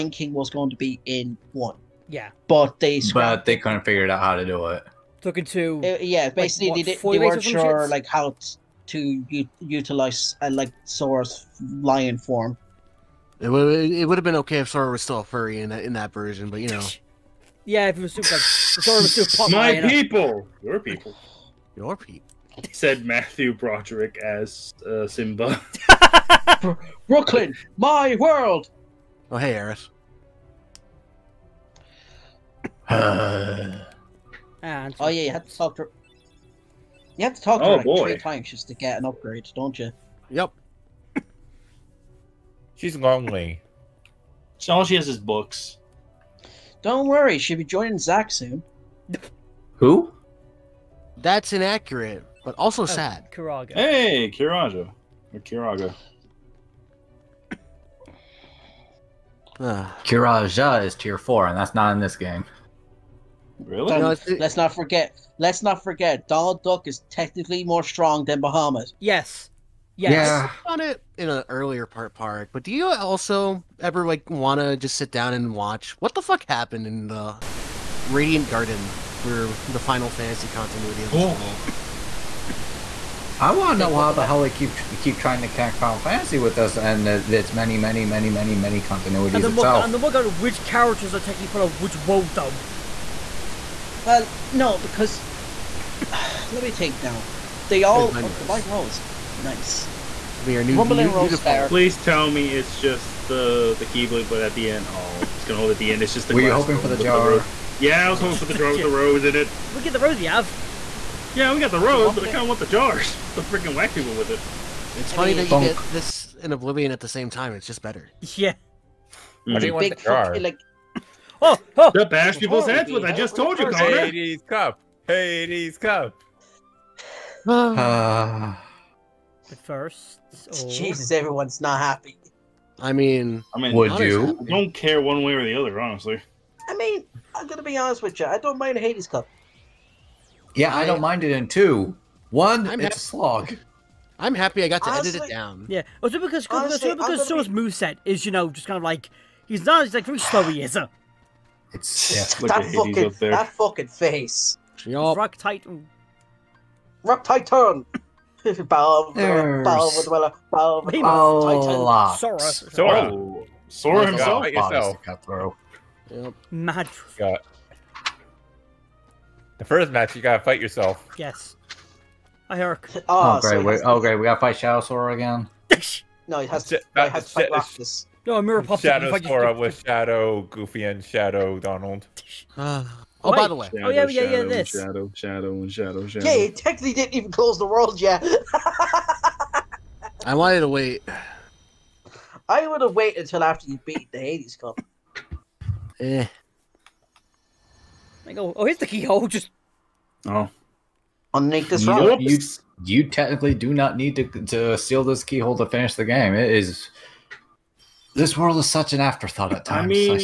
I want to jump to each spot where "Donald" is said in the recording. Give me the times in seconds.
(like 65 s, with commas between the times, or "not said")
66 s, 181 s.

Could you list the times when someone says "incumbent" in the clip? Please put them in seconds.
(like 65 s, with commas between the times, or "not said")
not said.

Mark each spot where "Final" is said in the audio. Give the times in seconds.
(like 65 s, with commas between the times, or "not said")
79 s, 85 s.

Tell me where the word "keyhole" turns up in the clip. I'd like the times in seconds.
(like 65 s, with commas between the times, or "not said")
198 s, 205 s.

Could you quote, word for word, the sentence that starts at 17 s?
Yeah, if it was super, Sora was super.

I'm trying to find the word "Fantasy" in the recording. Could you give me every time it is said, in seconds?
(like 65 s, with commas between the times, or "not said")
80 s, 85 s.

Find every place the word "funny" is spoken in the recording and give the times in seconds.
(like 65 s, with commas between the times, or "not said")
115 s.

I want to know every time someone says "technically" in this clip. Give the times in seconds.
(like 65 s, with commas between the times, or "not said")
67 s, 186 s, 203 s.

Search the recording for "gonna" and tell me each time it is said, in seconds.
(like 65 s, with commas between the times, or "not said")
105 s, 137 s.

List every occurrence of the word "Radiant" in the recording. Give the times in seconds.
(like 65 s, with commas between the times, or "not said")
77 s.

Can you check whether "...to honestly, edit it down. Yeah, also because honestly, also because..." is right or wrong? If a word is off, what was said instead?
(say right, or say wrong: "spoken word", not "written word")
right.